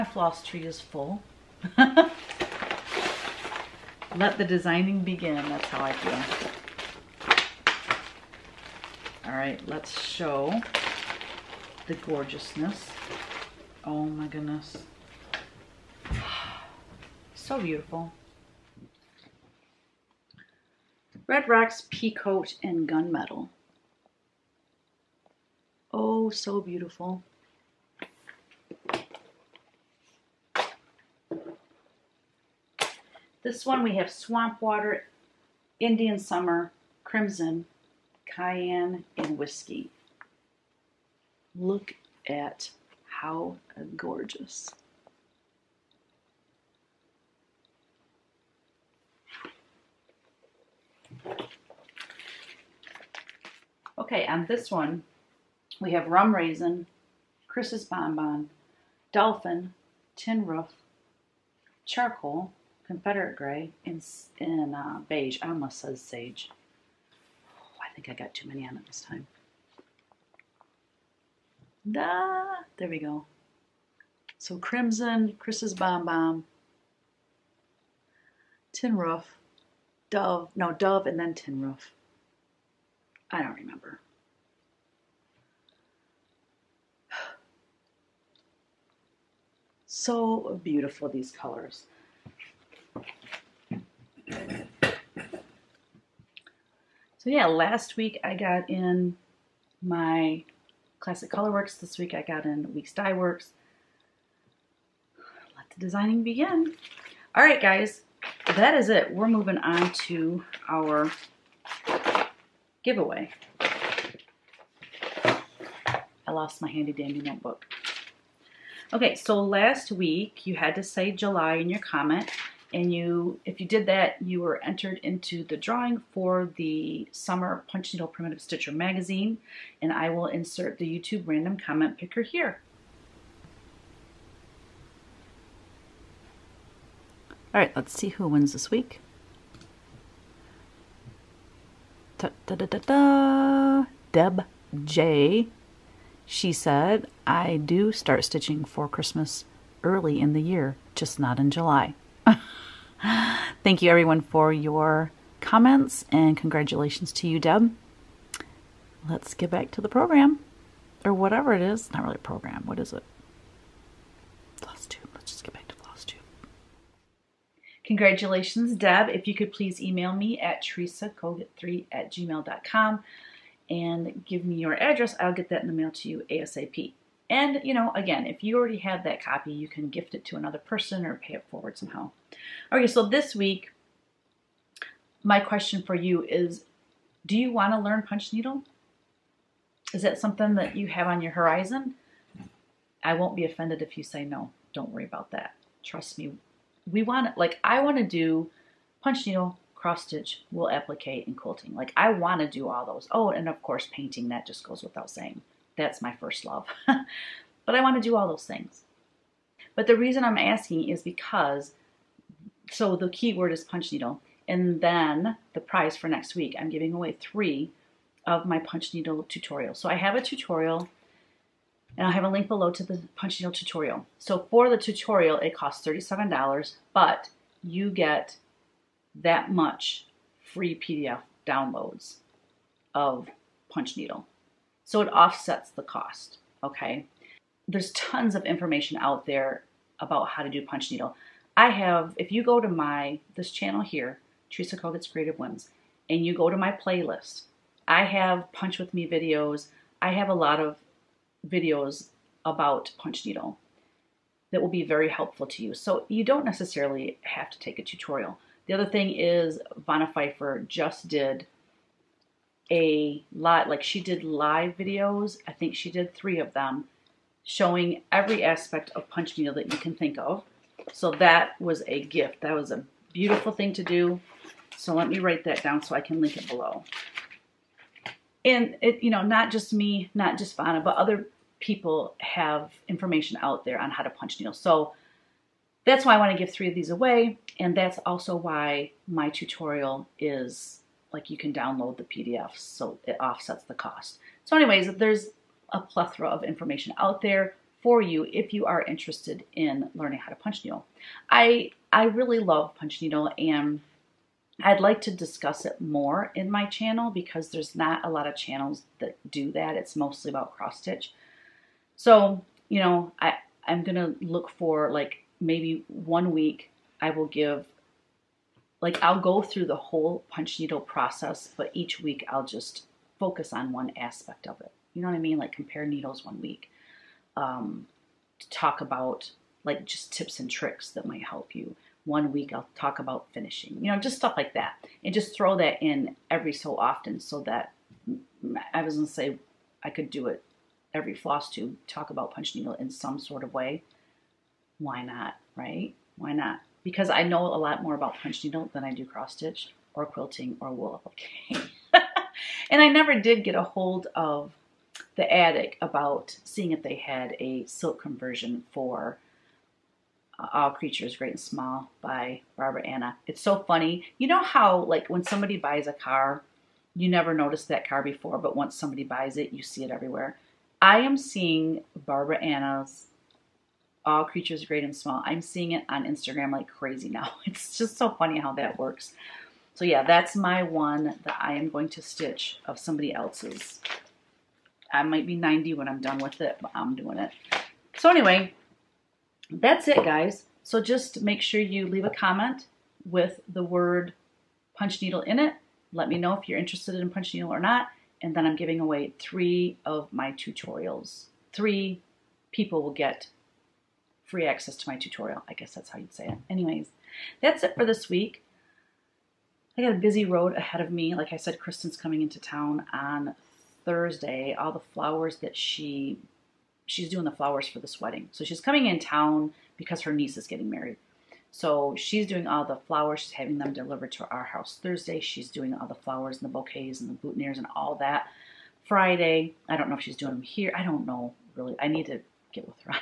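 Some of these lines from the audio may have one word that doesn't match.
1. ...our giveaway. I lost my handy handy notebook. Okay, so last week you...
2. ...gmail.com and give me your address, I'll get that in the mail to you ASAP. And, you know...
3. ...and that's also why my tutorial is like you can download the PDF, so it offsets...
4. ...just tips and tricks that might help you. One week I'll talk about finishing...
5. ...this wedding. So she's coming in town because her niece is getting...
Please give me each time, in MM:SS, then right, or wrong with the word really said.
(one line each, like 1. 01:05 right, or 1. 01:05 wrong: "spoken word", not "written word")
1. 01:50 wrong: "dandy", not "handy"
2. 02:52 right
3. 04:47 right
4. 05:29 right
5. 06:57 right.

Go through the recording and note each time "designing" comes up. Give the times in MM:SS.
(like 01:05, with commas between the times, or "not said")
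00:04, 01:45.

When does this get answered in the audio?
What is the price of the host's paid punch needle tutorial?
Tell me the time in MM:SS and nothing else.
03:45.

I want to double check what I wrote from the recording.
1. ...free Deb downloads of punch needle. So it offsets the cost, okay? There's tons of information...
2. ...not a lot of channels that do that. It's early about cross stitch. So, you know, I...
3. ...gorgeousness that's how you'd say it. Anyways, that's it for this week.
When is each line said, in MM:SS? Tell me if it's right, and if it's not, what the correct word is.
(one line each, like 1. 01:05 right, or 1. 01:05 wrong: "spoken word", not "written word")
1. 03:50 wrong: "PDF", not "Deb"
2. 05:07 wrong: "mostly", not "early"
3. 06:45 wrong: "guess", not "gorgeousness".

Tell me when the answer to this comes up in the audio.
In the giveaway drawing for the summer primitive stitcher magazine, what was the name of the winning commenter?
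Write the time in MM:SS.
02:24.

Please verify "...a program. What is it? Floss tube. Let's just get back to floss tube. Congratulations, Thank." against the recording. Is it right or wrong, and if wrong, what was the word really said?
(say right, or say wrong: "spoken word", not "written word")
wrong: "Deb", not "Thank".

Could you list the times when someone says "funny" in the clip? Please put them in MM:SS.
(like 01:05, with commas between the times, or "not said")
06:03, 06:18.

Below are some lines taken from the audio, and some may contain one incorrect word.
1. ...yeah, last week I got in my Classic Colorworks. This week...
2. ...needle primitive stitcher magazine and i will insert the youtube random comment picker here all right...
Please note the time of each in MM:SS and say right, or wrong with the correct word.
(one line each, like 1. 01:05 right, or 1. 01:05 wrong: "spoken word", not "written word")
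1. 01:37 right
2. 02:07 right.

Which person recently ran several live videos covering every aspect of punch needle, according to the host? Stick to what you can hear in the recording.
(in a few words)
Vonna Pfeiffer.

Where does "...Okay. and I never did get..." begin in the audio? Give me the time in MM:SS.
05:51.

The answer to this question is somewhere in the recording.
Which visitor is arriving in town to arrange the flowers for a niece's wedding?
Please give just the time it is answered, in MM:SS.
06:51.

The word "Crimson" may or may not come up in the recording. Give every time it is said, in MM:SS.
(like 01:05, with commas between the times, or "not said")
00:37, 01:14.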